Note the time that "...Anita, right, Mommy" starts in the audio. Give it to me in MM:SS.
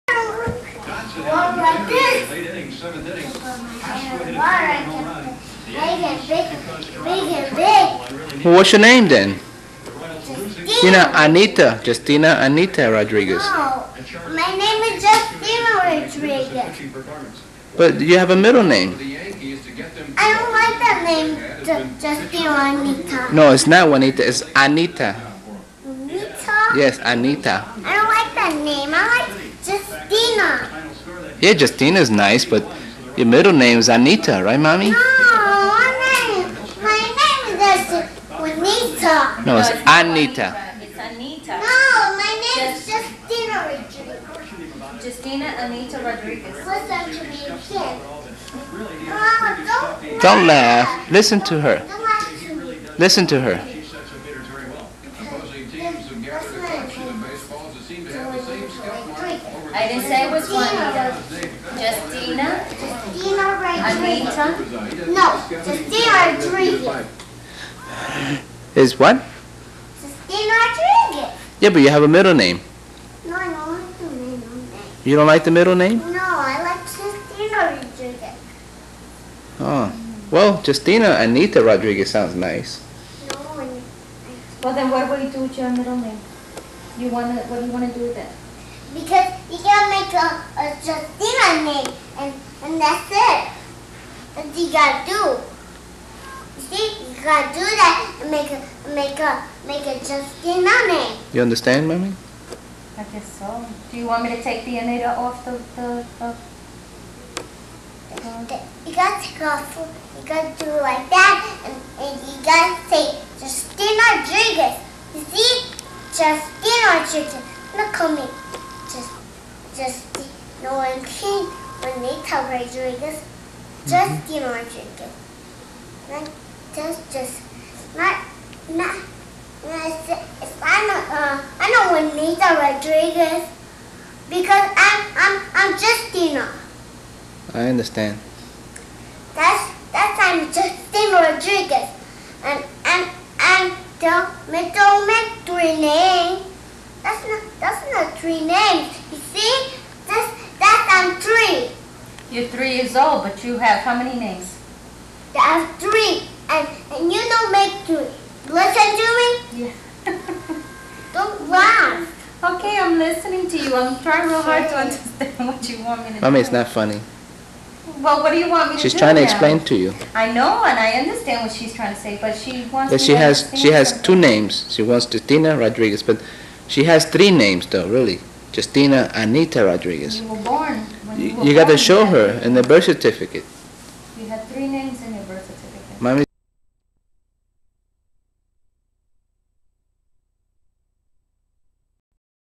00:33.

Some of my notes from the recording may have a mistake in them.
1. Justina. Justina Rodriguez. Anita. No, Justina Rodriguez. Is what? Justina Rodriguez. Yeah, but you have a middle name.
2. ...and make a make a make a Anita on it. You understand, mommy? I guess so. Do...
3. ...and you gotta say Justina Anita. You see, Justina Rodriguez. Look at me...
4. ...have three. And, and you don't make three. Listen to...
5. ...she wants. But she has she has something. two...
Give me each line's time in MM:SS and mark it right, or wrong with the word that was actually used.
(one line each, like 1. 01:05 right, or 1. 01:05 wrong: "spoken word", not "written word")
1. 01:01 right
2. 01:38 wrong: "Justine", not "Anita"
3. 01:51 wrong: "Rodriguez", not "Anita"
4. 02:35 right
5. 02:52 right.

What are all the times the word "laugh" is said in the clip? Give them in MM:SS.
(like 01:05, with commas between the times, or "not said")
00:50, 02:41.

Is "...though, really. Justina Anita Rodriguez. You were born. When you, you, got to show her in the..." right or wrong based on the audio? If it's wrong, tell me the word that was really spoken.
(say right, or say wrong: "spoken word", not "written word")
right.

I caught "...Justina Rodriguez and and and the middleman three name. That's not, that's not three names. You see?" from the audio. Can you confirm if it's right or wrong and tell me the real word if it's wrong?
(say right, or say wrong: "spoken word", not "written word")
right.